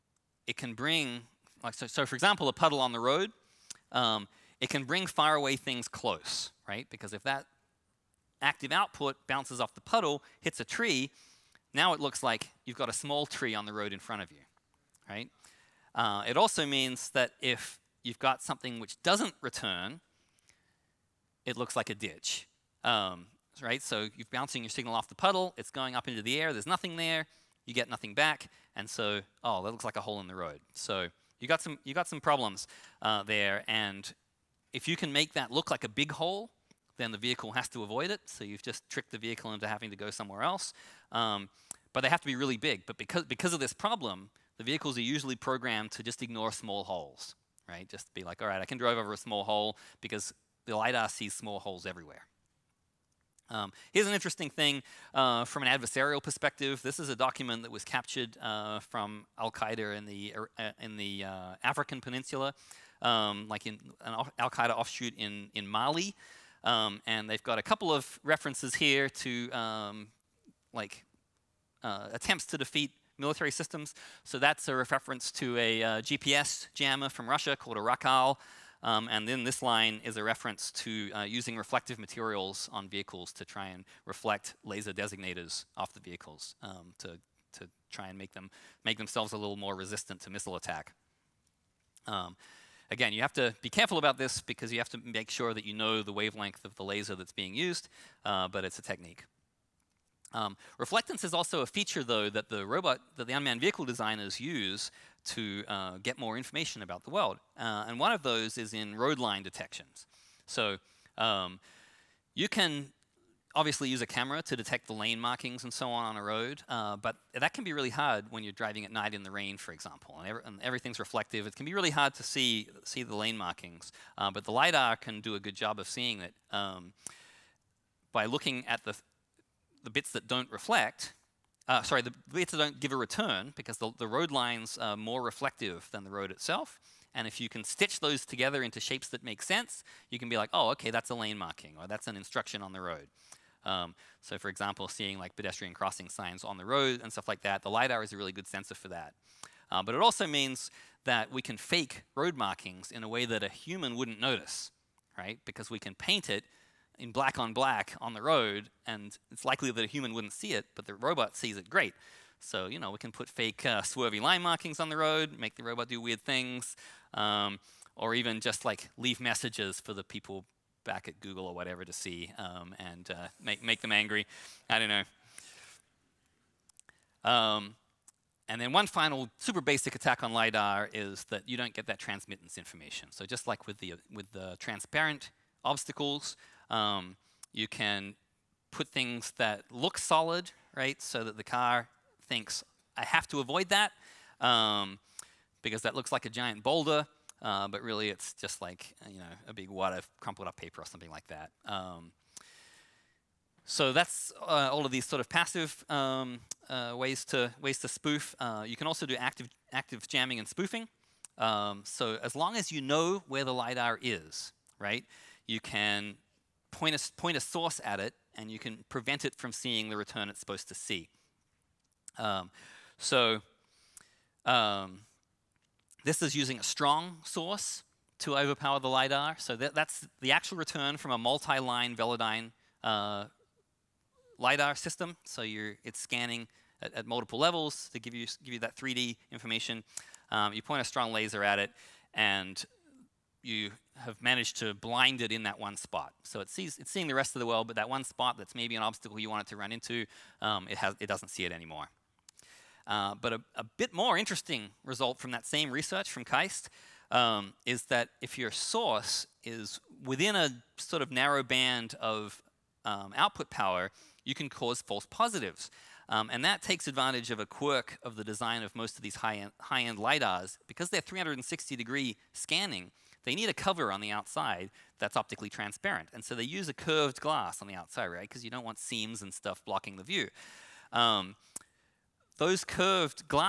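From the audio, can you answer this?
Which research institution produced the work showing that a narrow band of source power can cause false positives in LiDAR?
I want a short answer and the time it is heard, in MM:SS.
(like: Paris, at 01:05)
KAIST, at 04:16.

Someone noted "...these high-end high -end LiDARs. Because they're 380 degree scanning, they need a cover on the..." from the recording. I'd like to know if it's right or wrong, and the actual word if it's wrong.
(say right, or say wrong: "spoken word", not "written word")
wrong: "360", not "380".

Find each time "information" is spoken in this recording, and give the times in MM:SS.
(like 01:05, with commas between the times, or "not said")
01:46, 03:02, 03:59.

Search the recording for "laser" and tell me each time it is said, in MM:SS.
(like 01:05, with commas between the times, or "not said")
01:24, 01:36, 04:01.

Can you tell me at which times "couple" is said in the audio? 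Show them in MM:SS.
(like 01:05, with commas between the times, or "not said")
01:07.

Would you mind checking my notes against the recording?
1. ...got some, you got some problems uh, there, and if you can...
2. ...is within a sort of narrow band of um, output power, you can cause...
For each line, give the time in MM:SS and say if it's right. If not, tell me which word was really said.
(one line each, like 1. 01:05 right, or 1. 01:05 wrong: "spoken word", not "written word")
1. 00:31 right
2. 04:19 right.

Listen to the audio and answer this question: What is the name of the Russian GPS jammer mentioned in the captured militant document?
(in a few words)
Rakal.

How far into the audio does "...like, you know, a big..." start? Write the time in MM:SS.
03:18.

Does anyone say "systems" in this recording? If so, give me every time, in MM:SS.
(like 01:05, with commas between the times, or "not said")
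01:13, 03:54.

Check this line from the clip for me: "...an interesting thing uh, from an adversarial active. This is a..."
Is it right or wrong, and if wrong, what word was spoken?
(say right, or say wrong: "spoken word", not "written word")
wrong: "perspective", not "active".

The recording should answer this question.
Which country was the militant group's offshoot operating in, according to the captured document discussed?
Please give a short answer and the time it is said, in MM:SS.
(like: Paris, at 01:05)
Mali, at 01:05.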